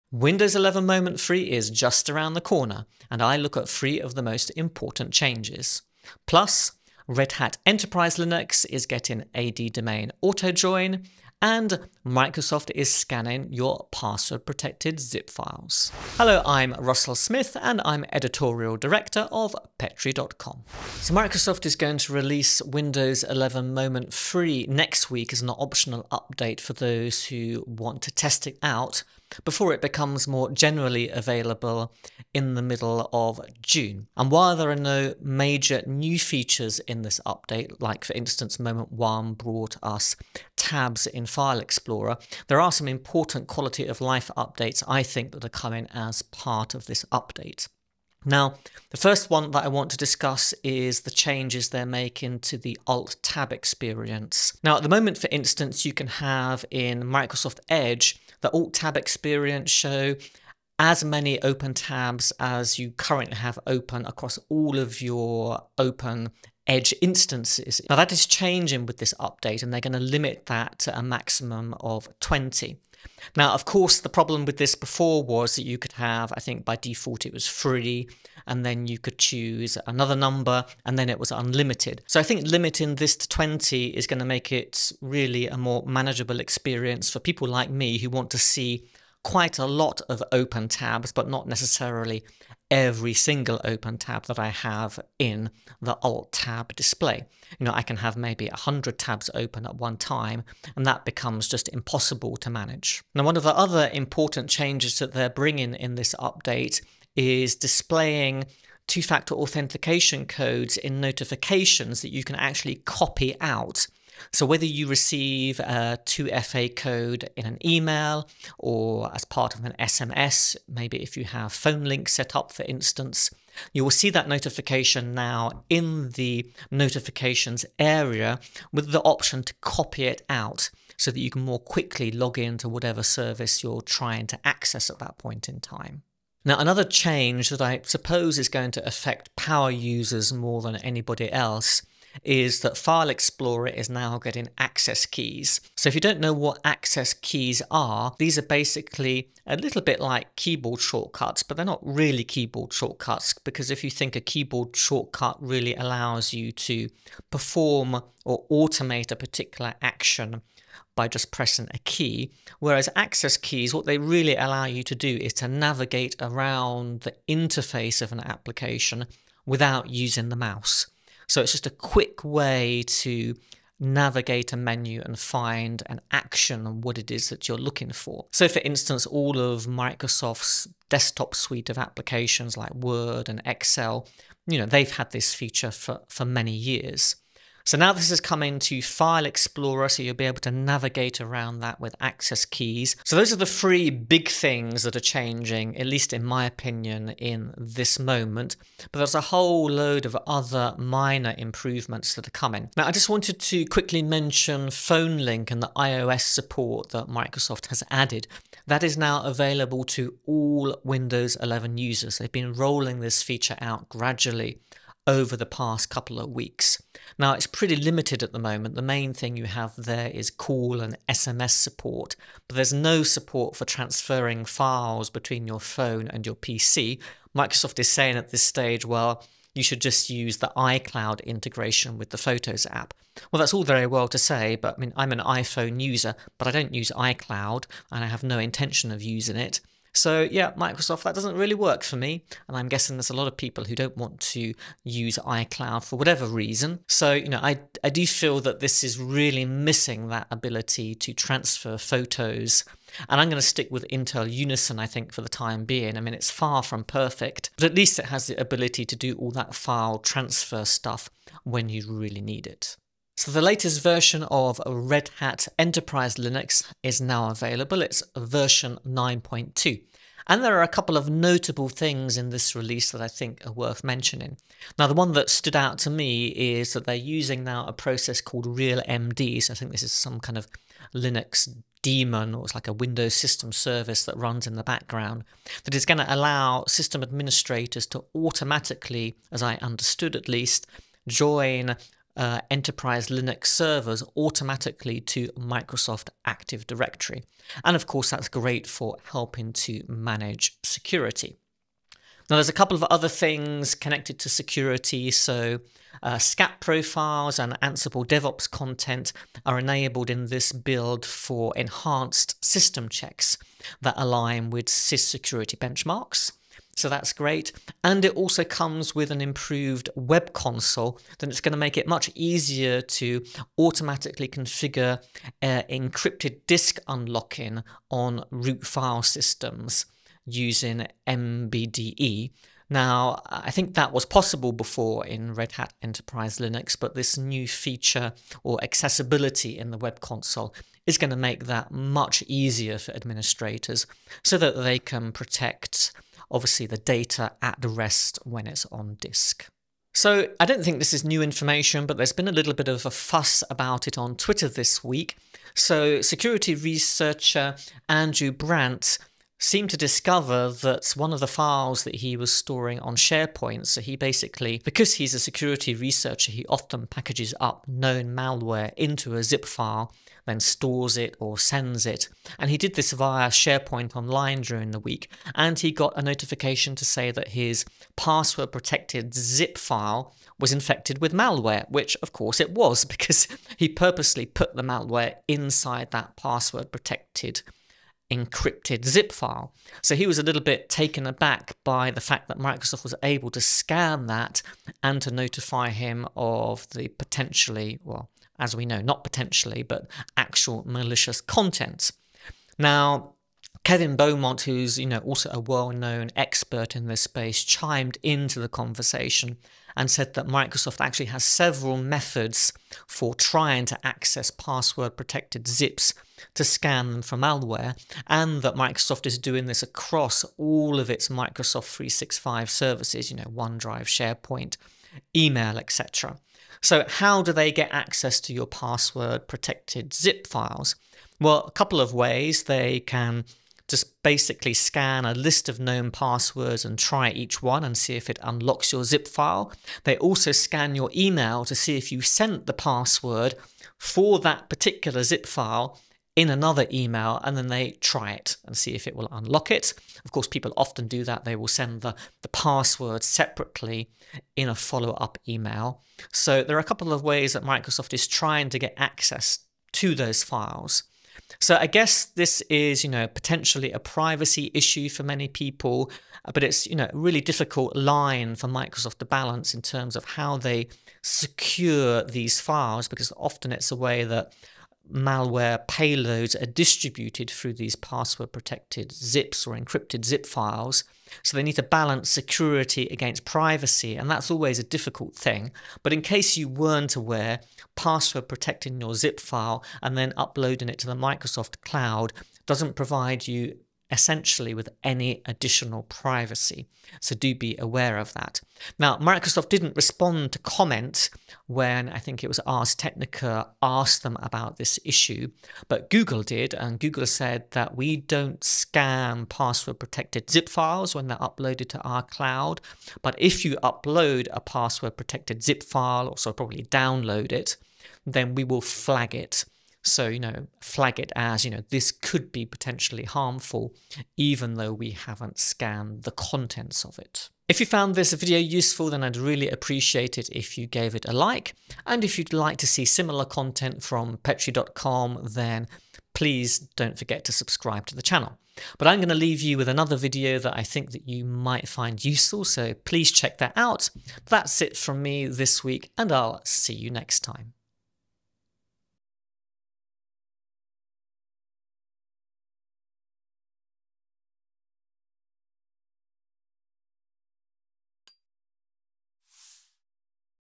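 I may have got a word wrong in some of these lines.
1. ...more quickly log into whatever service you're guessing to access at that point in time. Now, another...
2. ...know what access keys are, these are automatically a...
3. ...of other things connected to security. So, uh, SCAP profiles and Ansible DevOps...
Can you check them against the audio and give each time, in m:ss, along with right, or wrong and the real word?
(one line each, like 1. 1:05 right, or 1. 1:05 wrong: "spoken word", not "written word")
1. 2:11 wrong: "trying", not "guessing"
2. 2:26 wrong: "basically", not "automatically"
3. 5:02 right.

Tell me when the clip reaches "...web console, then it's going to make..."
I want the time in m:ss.
5:19.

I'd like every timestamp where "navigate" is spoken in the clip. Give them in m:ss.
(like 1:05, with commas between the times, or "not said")
2:45, 2:53, 3:10.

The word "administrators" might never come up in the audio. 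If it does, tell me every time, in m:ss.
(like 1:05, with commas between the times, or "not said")
4:47, 5:42.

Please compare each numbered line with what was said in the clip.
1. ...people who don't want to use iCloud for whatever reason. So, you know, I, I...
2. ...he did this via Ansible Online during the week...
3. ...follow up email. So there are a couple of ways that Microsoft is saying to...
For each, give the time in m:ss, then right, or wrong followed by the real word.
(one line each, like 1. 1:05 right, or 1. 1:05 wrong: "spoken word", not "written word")
1. 4:03 right
2. 6:12 wrong: "SharePoint", not "Ansible"
3. 7:34 wrong: "trying", not "saying".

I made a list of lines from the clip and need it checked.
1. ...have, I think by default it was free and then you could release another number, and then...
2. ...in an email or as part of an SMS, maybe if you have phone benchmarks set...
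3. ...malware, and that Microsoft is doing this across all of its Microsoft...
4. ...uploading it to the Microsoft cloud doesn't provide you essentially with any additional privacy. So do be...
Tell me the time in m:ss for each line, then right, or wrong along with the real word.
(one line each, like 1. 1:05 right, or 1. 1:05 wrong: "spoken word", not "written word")
1. 1:15 wrong: "choose", not "release"
2. 1:57 wrong: "links", not "benchmarks"
3. 6:57 right
4. 8:10 right.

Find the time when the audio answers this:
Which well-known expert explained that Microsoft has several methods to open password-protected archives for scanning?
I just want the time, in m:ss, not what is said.
6:43.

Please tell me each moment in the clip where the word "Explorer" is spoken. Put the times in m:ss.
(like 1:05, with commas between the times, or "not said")
0:41, 2:23, 3:09.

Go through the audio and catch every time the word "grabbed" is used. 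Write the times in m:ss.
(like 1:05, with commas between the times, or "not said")
not said.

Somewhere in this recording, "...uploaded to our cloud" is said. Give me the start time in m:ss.
8:31.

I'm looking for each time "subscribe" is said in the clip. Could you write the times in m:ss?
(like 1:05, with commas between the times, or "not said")
8:57.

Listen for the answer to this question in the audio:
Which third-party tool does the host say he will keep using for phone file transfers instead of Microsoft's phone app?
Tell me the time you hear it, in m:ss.
4:13.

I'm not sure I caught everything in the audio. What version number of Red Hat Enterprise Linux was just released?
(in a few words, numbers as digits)
9.2.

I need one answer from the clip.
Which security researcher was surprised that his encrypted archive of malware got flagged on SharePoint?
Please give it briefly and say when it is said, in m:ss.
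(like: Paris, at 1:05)
Andrew Brandt, at 5:57.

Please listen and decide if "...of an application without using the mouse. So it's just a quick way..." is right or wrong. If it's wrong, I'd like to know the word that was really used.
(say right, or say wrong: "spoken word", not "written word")
right.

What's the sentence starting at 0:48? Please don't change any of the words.
Now, the first one that I want to discuss is the changes they're making to the Alt Tab experience.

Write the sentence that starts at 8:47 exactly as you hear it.
If you found this video useful, then I'd really appreciate it if you gave it a like.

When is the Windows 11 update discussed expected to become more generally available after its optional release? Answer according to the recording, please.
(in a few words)
Middle of June.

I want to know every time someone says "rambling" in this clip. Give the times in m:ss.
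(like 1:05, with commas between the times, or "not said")
not said.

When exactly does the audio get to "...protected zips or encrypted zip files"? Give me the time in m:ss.
7:58.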